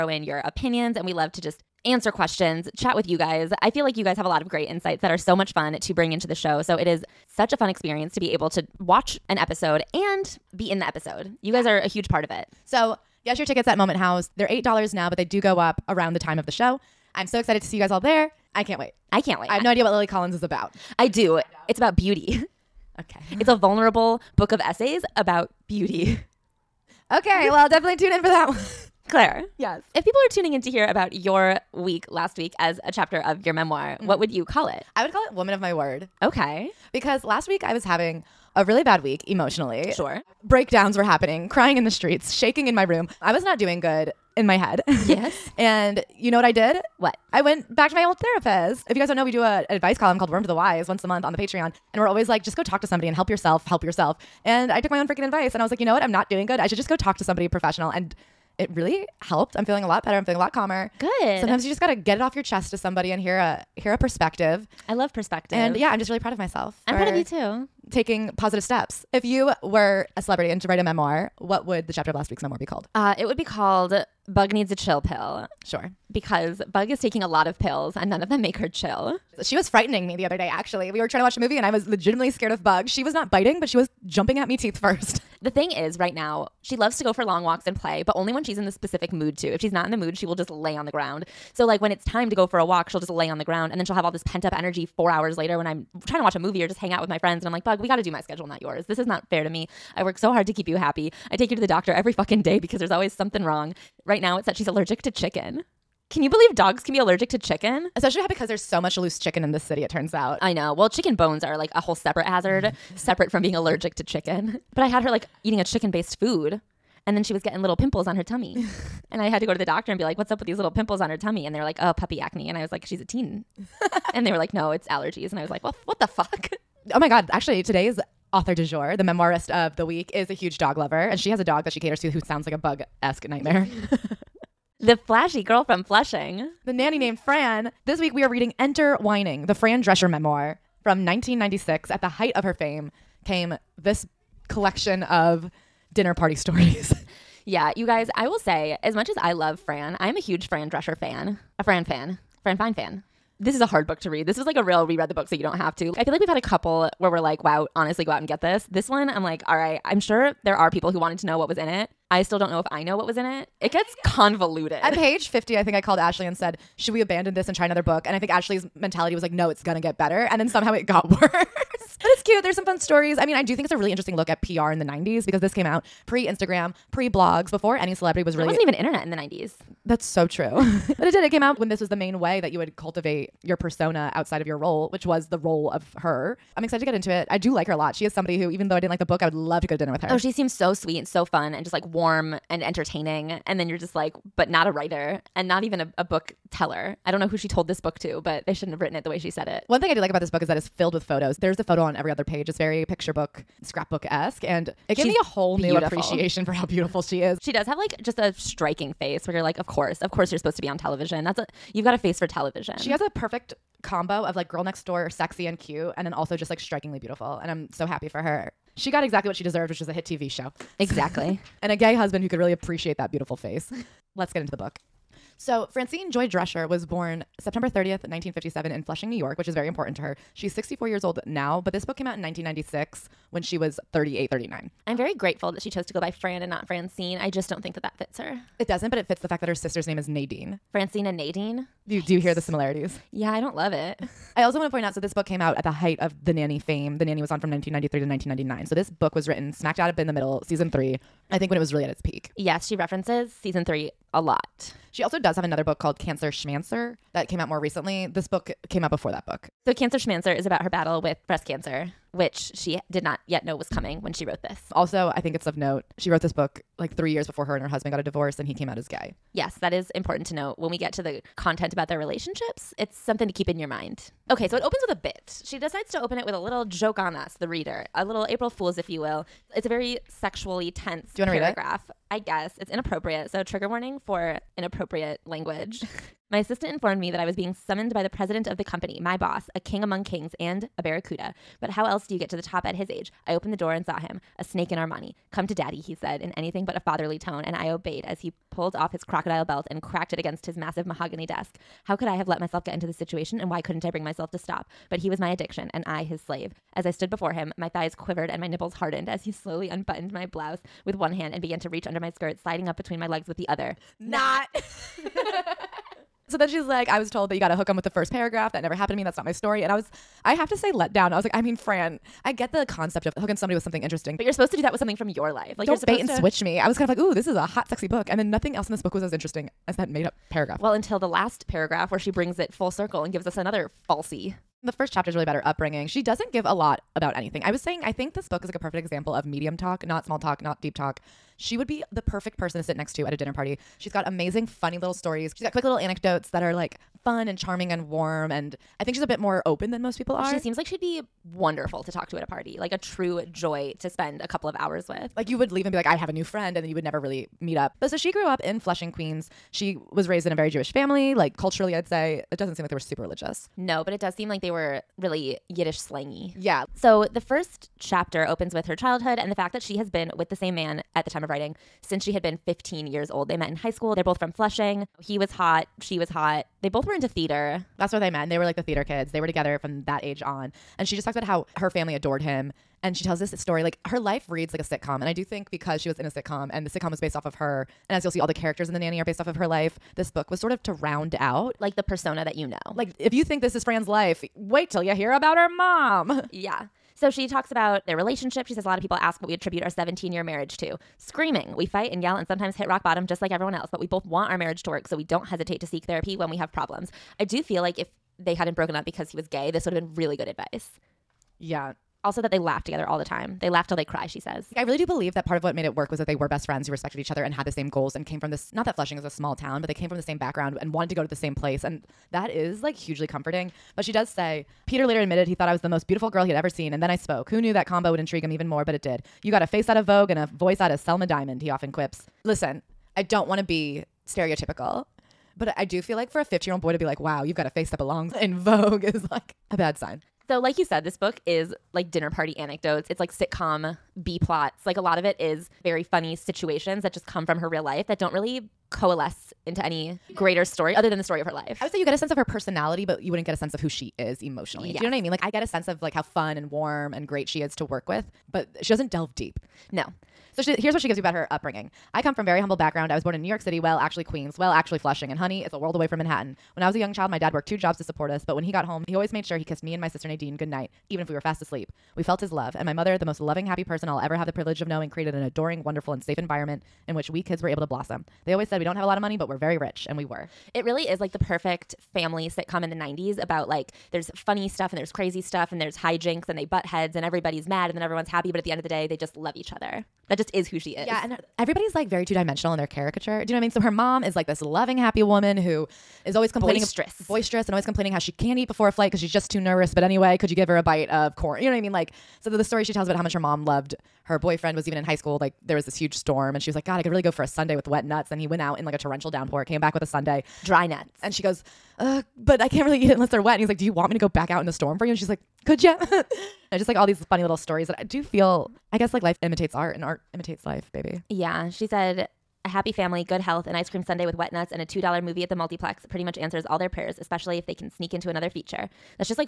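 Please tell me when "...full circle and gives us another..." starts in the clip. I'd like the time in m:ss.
5:32.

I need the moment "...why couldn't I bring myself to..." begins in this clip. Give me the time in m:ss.
5:03.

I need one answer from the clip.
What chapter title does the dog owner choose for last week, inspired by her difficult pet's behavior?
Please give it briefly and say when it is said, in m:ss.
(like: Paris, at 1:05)
Bug Needs a Chill Pill, at 1:14.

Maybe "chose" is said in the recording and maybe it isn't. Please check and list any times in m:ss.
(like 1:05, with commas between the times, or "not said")
3:55.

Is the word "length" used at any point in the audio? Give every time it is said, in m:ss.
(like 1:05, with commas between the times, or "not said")
not said.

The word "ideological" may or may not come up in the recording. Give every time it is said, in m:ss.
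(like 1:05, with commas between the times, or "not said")
not said.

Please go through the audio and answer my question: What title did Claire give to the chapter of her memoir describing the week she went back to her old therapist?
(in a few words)
Woman of My Word.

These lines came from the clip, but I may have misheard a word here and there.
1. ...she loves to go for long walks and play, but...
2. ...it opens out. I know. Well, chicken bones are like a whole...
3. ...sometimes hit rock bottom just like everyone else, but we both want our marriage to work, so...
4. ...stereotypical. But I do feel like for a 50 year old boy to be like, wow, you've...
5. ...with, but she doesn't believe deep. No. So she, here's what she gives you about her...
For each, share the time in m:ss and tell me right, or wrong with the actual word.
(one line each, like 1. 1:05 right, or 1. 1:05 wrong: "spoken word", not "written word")
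1. 1:26 right
2. 1:49 wrong: "turns", not "opens"
3. 6:42 right
4. 7:14 right
5. 7:37 wrong: "delve", not "believe".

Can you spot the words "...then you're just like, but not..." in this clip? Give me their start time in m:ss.
3:13.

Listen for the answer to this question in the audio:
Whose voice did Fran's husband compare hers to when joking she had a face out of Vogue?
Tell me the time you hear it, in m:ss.
7:10.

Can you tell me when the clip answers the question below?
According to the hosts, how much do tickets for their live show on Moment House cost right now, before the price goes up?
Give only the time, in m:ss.
0:14.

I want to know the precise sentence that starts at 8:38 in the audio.
I guess like life imitates art and art imitates life, baby.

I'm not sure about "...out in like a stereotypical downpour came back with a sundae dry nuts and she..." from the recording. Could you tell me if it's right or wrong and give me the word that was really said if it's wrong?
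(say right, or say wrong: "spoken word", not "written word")
wrong: "torrential", not "stereotypical".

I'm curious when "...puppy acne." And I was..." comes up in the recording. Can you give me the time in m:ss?
2:01.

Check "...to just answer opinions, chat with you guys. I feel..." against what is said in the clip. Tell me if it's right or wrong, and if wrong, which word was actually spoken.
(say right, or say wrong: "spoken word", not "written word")
wrong: "questions", not "opinions".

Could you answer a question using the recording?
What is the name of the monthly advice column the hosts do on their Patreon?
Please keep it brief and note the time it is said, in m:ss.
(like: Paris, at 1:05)
Worm to the Wise, at 0:50.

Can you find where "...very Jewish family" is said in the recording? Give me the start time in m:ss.
6:00.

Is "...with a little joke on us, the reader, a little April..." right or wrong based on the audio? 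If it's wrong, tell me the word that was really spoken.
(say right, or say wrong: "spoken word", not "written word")
right.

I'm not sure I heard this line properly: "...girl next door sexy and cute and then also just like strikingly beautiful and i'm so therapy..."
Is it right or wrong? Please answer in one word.
wrong.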